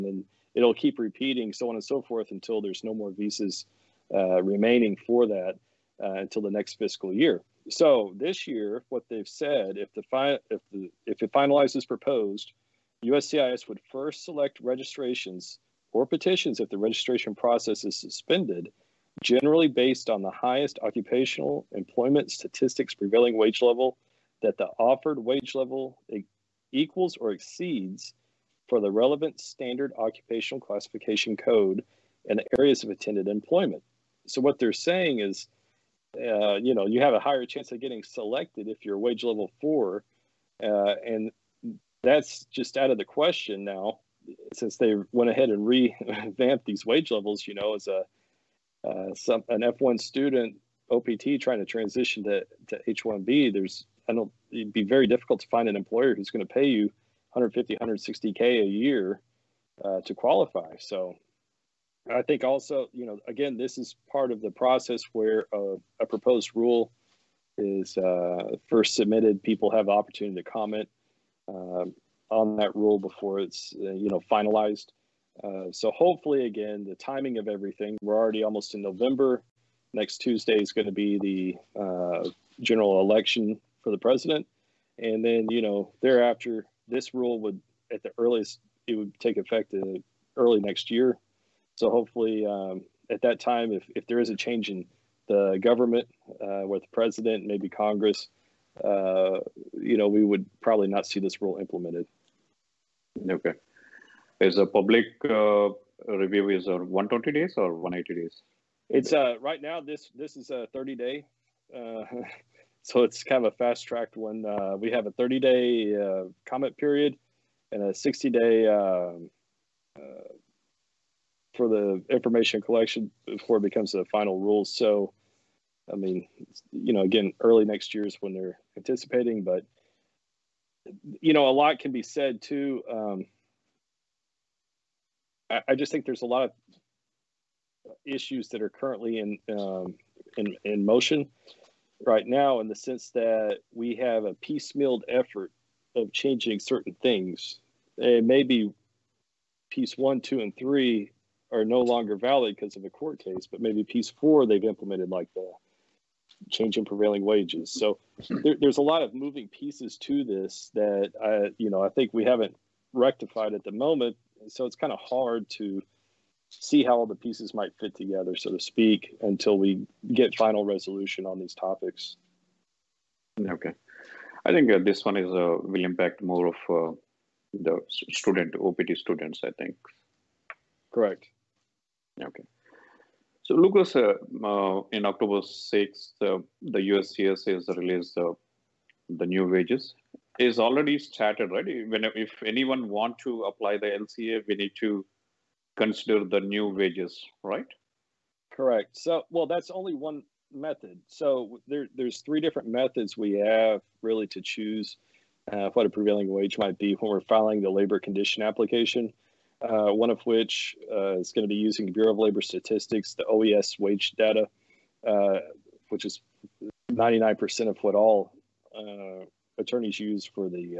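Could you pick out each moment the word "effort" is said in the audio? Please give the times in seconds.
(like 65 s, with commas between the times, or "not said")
145 s.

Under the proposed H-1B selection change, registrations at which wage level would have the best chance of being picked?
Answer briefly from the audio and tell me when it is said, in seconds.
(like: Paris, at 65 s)
Level 4, at 38 s.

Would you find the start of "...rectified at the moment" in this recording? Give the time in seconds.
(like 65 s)
162 s.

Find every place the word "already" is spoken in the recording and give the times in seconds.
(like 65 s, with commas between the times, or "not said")
78 s, 190 s.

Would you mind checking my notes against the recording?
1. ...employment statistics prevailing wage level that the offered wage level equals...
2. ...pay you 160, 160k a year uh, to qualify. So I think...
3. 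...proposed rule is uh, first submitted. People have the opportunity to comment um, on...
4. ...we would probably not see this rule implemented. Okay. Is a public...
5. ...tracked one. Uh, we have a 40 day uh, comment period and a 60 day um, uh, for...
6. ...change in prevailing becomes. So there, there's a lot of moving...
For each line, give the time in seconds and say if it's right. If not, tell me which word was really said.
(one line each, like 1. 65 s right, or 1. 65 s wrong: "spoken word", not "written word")
1. 21 s right
2. 56 s wrong: "150", not "160"
3. 66 s right
4. 100 s right
5. 113 s wrong: "30", not "40"
6. 156 s wrong: "wages", not "becomes".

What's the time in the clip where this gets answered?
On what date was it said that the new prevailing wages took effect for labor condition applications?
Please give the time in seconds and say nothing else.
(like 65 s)
185 s.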